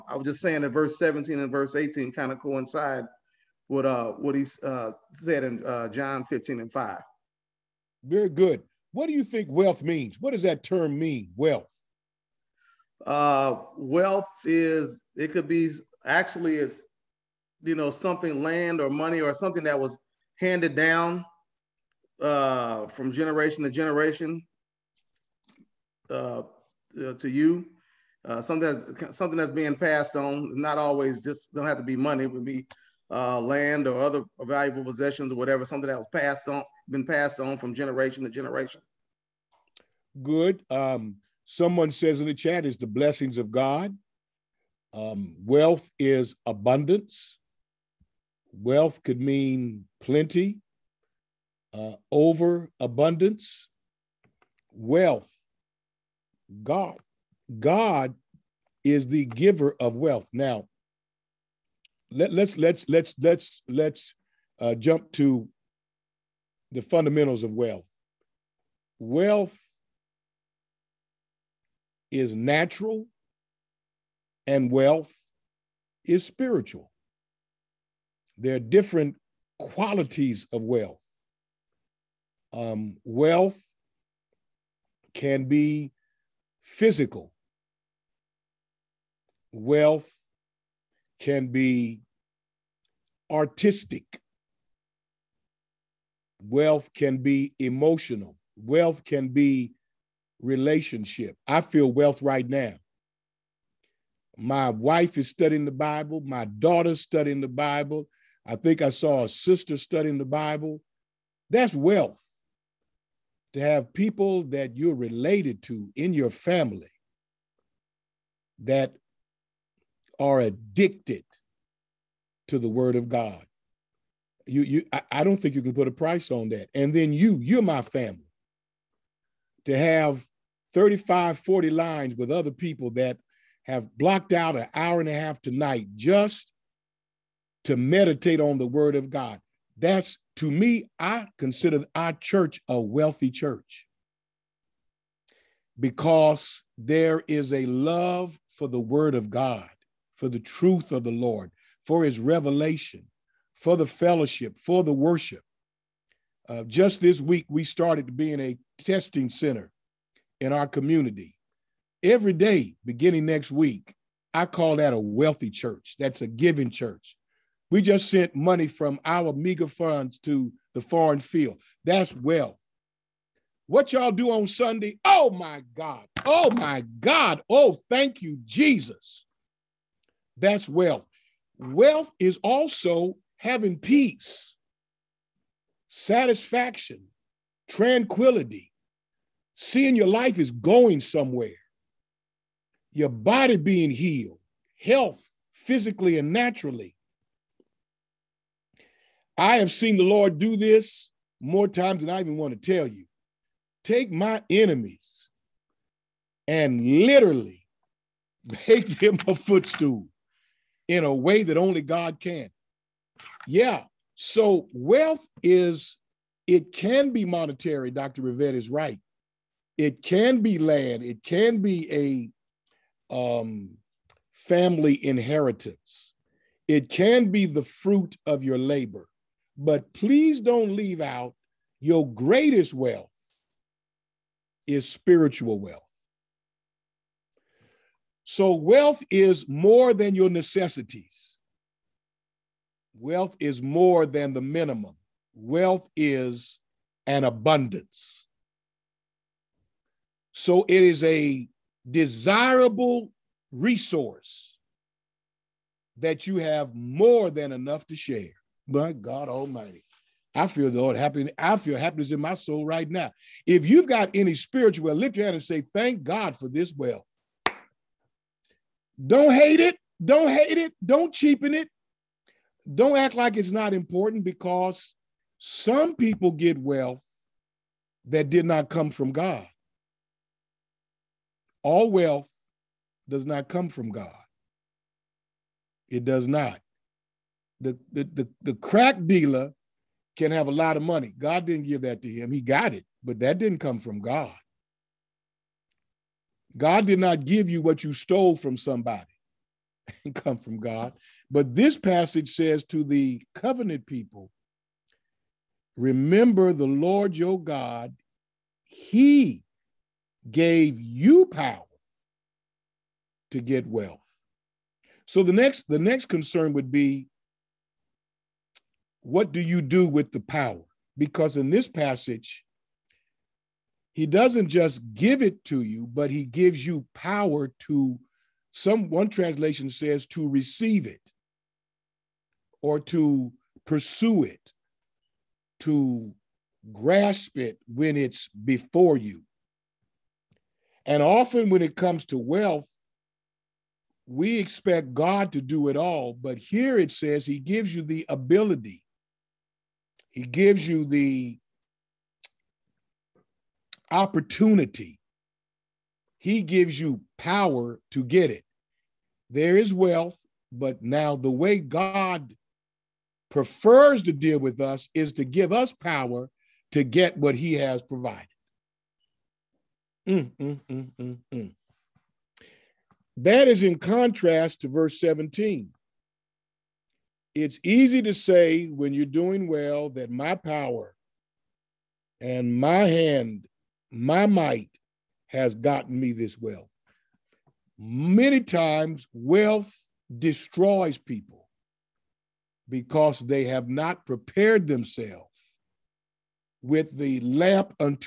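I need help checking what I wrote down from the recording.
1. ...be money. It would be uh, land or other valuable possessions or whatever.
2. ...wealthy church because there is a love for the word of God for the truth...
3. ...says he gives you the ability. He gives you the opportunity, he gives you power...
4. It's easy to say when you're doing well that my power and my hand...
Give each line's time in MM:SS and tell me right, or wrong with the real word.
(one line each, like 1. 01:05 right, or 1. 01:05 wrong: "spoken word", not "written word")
1. 00:31 right
2. 02:22 right
3. 05:46 right
4. 06:17 right.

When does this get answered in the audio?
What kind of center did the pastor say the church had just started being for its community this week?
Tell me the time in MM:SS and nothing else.
02:38.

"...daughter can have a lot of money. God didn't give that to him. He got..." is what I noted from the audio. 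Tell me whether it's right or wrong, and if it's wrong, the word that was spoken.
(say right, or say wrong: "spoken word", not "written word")
wrong: "dealer", not "daughter".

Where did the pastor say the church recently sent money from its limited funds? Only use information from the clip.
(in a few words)
The foreign field.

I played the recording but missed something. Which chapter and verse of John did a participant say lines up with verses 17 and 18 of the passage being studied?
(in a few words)
John 15:5.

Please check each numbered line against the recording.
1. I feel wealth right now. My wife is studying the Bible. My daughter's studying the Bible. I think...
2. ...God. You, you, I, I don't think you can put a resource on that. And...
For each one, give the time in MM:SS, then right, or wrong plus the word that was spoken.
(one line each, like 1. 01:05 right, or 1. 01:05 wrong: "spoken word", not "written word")
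1. 01:41 right
2. 02:03 wrong: "price", not "resource".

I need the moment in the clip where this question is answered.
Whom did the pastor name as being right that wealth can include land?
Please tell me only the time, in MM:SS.
03:37.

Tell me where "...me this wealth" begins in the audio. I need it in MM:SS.
06:25.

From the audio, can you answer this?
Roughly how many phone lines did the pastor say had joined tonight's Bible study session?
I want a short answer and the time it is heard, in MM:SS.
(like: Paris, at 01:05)
35 to 40, at 02:10.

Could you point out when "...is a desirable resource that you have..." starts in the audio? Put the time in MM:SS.
04:10.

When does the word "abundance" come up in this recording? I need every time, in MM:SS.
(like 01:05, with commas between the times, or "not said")
00:46, 00:52, 04:07.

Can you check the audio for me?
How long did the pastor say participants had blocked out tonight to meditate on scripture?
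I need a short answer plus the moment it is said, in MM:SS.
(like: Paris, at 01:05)
An hour and a half, at 02:14.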